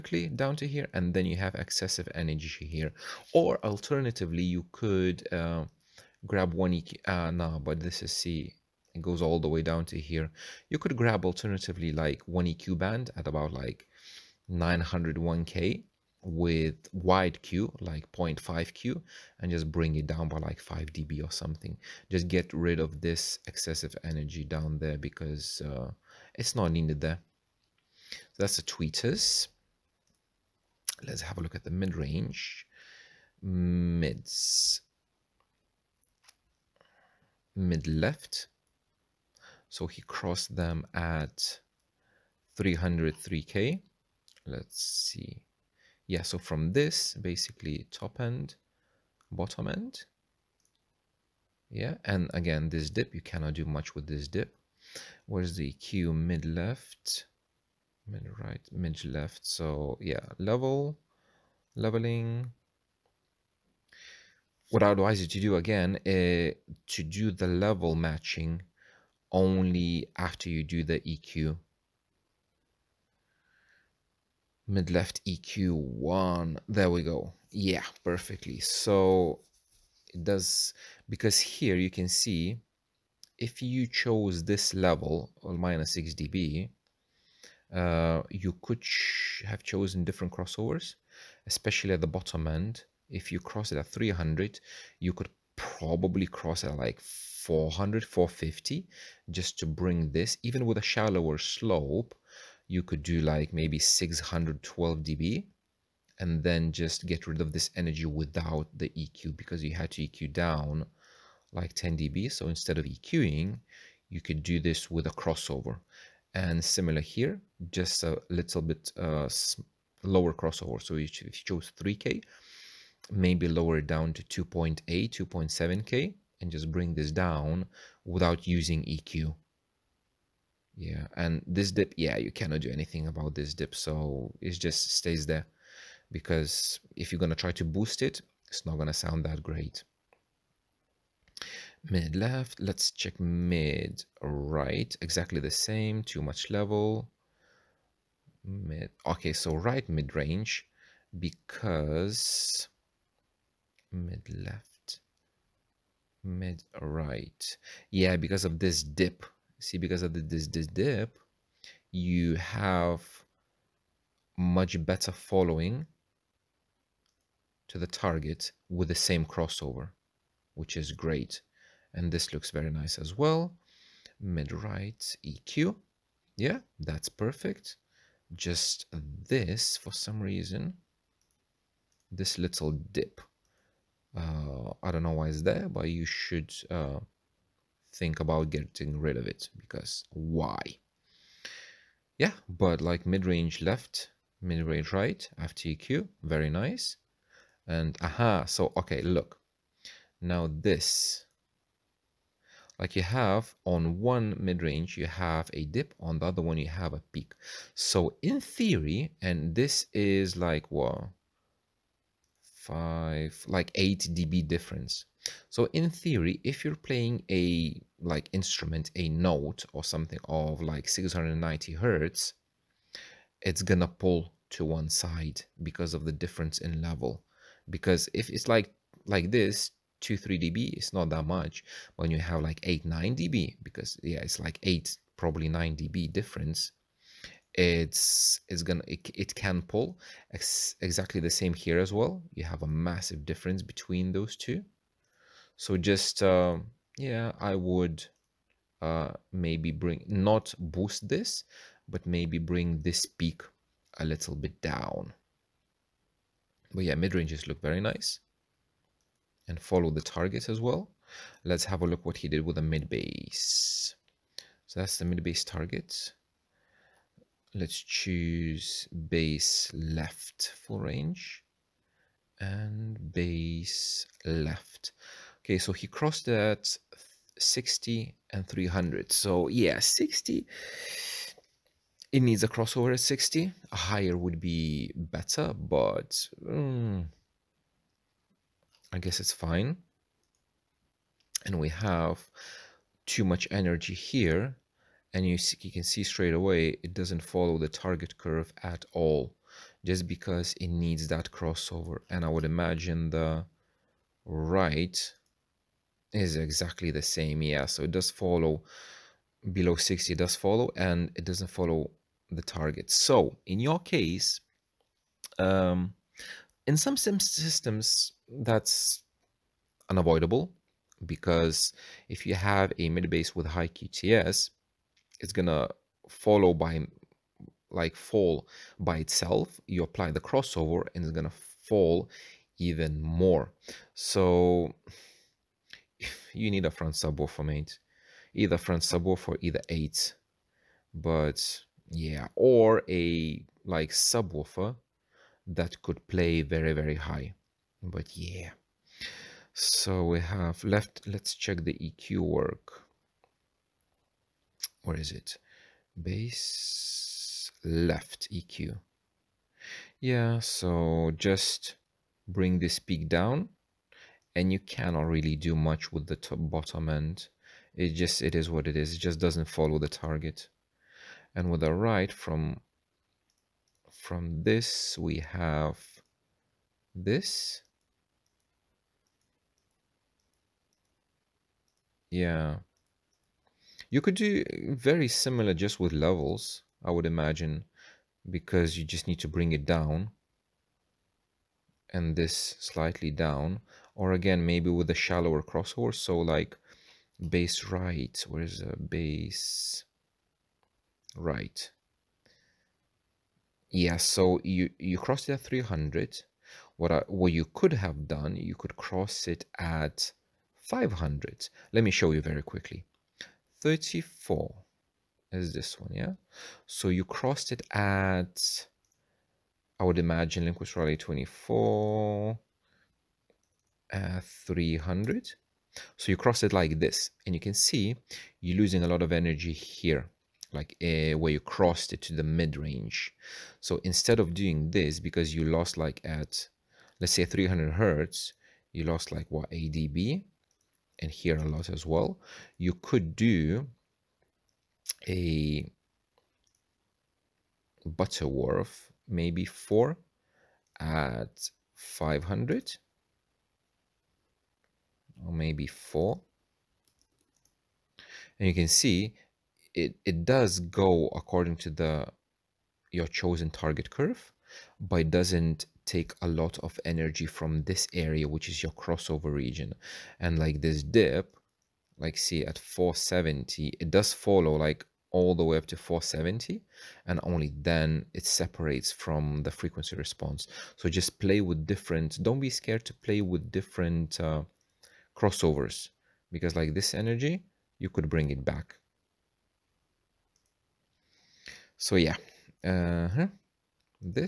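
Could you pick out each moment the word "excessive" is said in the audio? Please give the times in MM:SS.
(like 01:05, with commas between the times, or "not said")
00:01, 00:23.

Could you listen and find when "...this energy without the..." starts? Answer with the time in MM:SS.
01:47.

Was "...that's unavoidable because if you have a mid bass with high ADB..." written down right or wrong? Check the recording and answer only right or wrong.
wrong.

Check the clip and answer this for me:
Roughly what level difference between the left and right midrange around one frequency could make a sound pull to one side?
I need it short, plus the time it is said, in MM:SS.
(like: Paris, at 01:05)
8 dB, at 03:33.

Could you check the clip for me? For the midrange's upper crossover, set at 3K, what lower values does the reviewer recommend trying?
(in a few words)
2.8 or 2.7K.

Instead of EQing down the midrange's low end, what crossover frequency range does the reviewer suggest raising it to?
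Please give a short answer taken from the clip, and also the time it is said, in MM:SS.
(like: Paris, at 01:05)
400 to 450, at 01:36.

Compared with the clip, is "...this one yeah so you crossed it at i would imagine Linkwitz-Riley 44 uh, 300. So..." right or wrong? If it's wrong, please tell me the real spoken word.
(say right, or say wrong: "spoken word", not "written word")
wrong: "24", not "44".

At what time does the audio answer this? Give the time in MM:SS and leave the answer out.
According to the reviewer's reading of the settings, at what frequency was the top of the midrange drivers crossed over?
00:42.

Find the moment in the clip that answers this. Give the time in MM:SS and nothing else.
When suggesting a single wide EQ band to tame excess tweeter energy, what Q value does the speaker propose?
00:18.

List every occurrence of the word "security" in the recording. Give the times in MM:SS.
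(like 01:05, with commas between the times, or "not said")
not said.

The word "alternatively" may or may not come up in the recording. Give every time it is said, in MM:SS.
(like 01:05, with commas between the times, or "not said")
00:03, 00:11.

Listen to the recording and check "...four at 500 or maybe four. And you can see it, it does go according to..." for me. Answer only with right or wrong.
right.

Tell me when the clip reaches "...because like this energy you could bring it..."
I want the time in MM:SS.
08:06.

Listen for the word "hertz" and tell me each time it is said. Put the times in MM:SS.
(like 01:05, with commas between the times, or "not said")
03:41, 07:17.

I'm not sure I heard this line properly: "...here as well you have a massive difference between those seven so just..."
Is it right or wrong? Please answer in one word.
wrong.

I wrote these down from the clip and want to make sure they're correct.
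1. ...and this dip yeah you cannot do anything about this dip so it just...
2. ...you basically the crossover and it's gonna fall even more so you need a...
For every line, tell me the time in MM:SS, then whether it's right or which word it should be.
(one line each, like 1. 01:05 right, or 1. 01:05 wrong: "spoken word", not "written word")
1. 02:11 right
2. 05:29 wrong: "apply", not "basically".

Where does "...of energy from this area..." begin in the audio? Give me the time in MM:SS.
07:46.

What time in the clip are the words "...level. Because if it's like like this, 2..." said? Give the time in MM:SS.
03:46.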